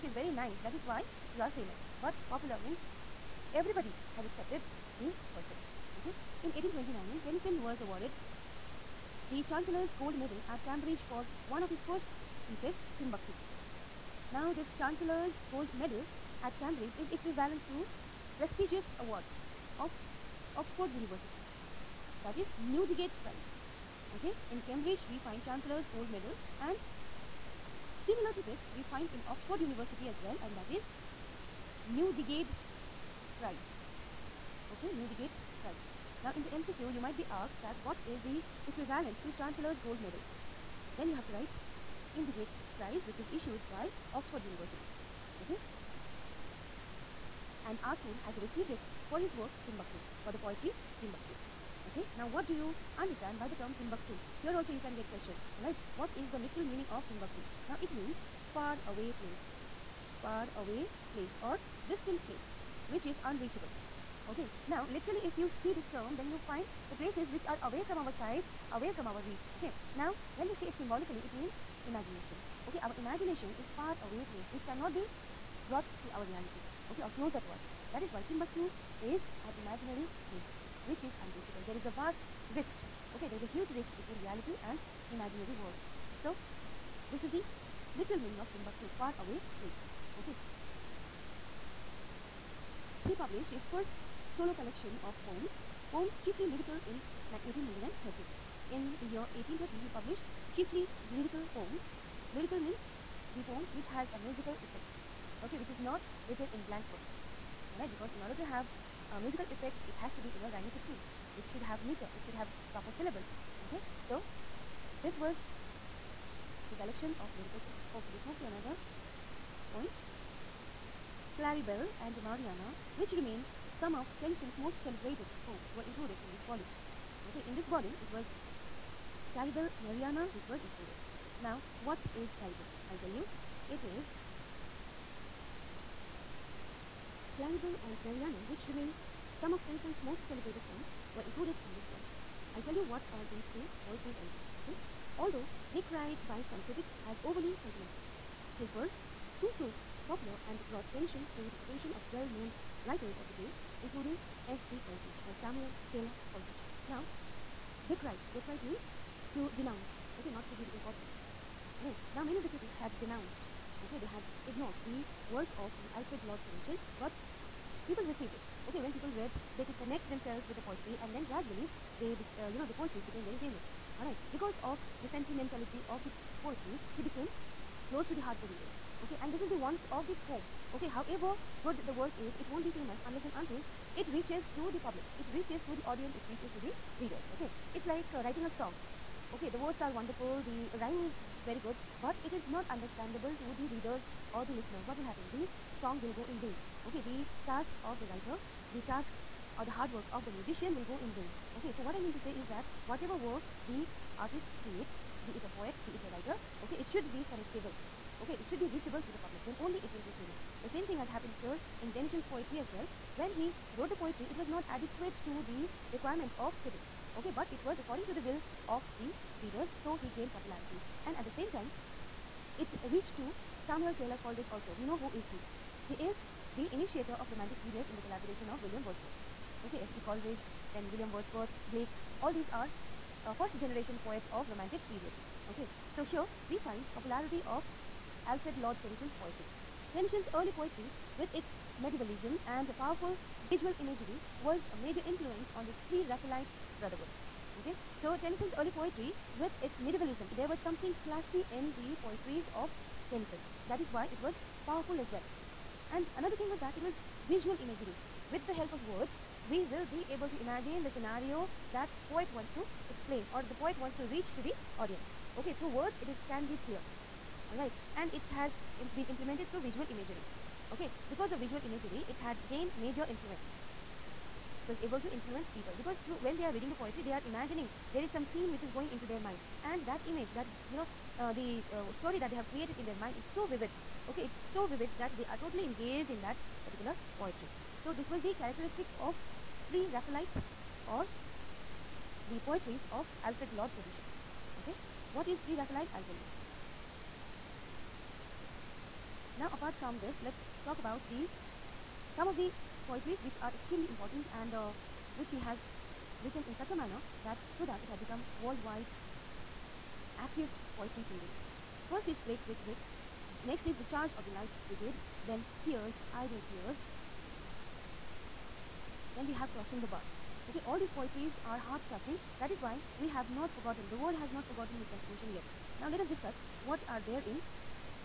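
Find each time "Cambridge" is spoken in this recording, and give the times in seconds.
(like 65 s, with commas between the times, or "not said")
10 s, 16 s, 24 s.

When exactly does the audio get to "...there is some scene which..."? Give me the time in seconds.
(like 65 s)
277 s.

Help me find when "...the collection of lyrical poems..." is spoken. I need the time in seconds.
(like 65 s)
116 s.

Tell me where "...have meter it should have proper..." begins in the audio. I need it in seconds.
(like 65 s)
111 s.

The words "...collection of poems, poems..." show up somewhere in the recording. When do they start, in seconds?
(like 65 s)
94 s.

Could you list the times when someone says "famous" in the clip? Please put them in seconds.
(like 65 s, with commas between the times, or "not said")
1 s, 173 s, 182 s, 210 s.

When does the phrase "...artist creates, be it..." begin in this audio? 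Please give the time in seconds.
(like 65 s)
204 s.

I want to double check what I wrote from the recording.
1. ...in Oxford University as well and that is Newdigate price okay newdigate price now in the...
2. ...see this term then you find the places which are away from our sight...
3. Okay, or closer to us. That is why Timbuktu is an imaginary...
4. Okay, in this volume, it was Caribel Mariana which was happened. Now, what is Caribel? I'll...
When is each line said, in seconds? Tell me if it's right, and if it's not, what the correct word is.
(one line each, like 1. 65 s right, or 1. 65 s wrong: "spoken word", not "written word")
1. 29 s right
2. 65 s right
3. 76 s right
4. 127 s wrong: "included", not "happened".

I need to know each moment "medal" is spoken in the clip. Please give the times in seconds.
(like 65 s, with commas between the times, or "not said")
10 s, 15 s, 26 s, 39 s.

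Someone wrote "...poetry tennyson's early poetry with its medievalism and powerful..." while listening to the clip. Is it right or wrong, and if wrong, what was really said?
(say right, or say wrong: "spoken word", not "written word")
right.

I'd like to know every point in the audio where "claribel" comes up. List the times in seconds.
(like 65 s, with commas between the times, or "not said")
121 s, 137 s.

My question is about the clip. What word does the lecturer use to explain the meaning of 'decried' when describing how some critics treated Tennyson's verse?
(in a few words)
denounce.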